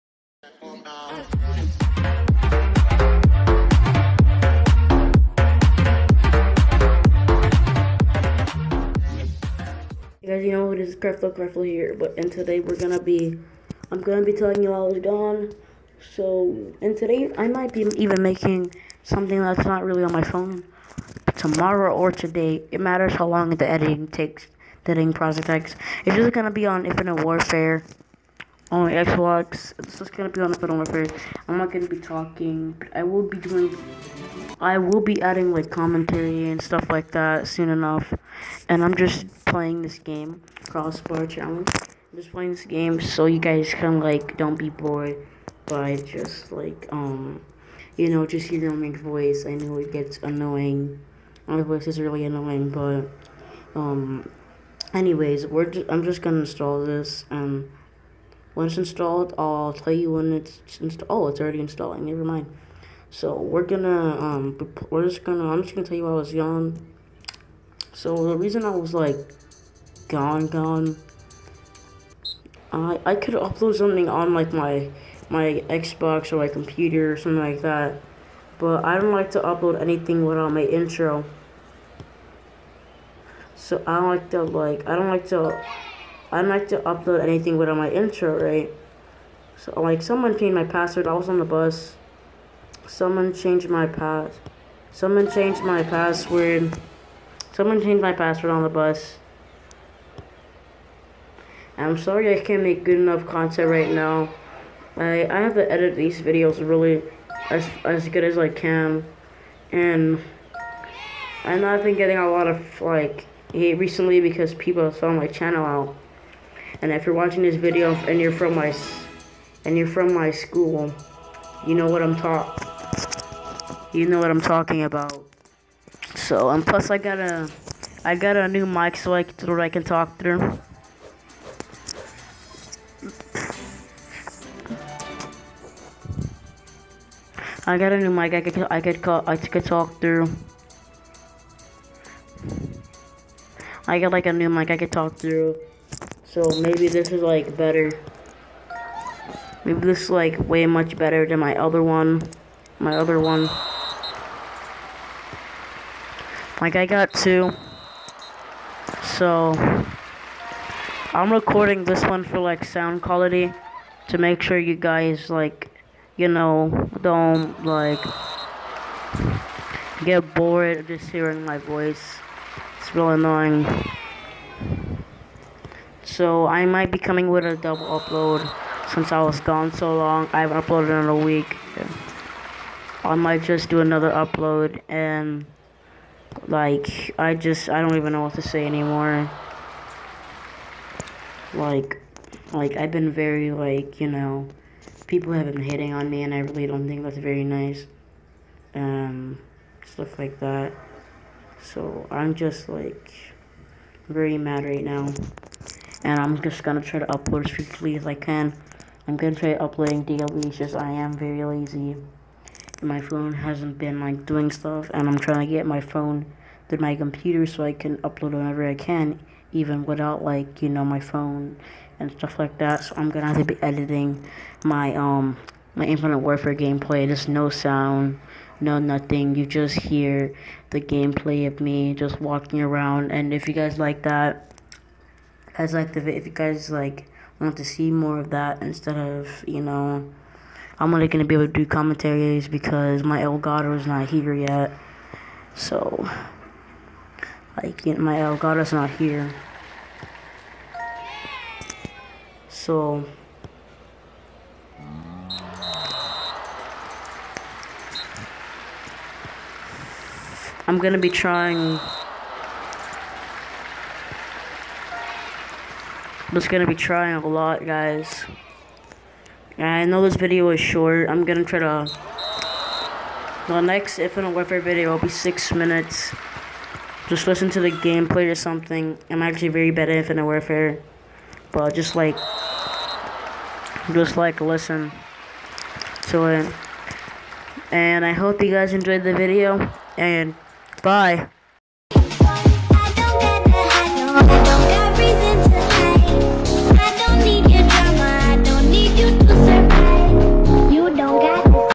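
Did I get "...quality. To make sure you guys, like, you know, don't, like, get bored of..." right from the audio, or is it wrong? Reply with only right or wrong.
right.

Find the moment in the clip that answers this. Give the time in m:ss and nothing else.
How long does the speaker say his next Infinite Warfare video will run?
4:35.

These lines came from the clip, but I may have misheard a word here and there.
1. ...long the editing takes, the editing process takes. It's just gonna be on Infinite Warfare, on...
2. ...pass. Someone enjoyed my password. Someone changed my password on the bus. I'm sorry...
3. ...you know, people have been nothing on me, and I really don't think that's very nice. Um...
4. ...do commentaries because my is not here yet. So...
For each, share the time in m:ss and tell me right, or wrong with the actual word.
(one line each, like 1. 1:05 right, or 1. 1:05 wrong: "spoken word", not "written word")
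1. 0:23 right
2. 1:33 wrong: "changed", not "enjoyed"
3. 3:13 wrong: "hitting", not "nothing"
4. 4:01 right.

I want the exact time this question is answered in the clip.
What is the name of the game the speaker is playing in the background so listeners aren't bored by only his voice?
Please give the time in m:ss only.
0:40.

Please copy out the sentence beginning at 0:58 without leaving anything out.
Once installed, I'll tell you when it's installed.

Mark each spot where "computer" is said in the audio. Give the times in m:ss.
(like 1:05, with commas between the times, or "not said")
1:16, 3:36.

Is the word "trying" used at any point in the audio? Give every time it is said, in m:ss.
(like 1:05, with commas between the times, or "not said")
3:35, 4:21, 4:26.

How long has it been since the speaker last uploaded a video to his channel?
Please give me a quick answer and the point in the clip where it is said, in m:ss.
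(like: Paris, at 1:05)
A week, at 3:01.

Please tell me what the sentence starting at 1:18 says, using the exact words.
But I don't like to upload anything without my intro.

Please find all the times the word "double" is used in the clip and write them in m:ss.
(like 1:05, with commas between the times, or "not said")
2:57.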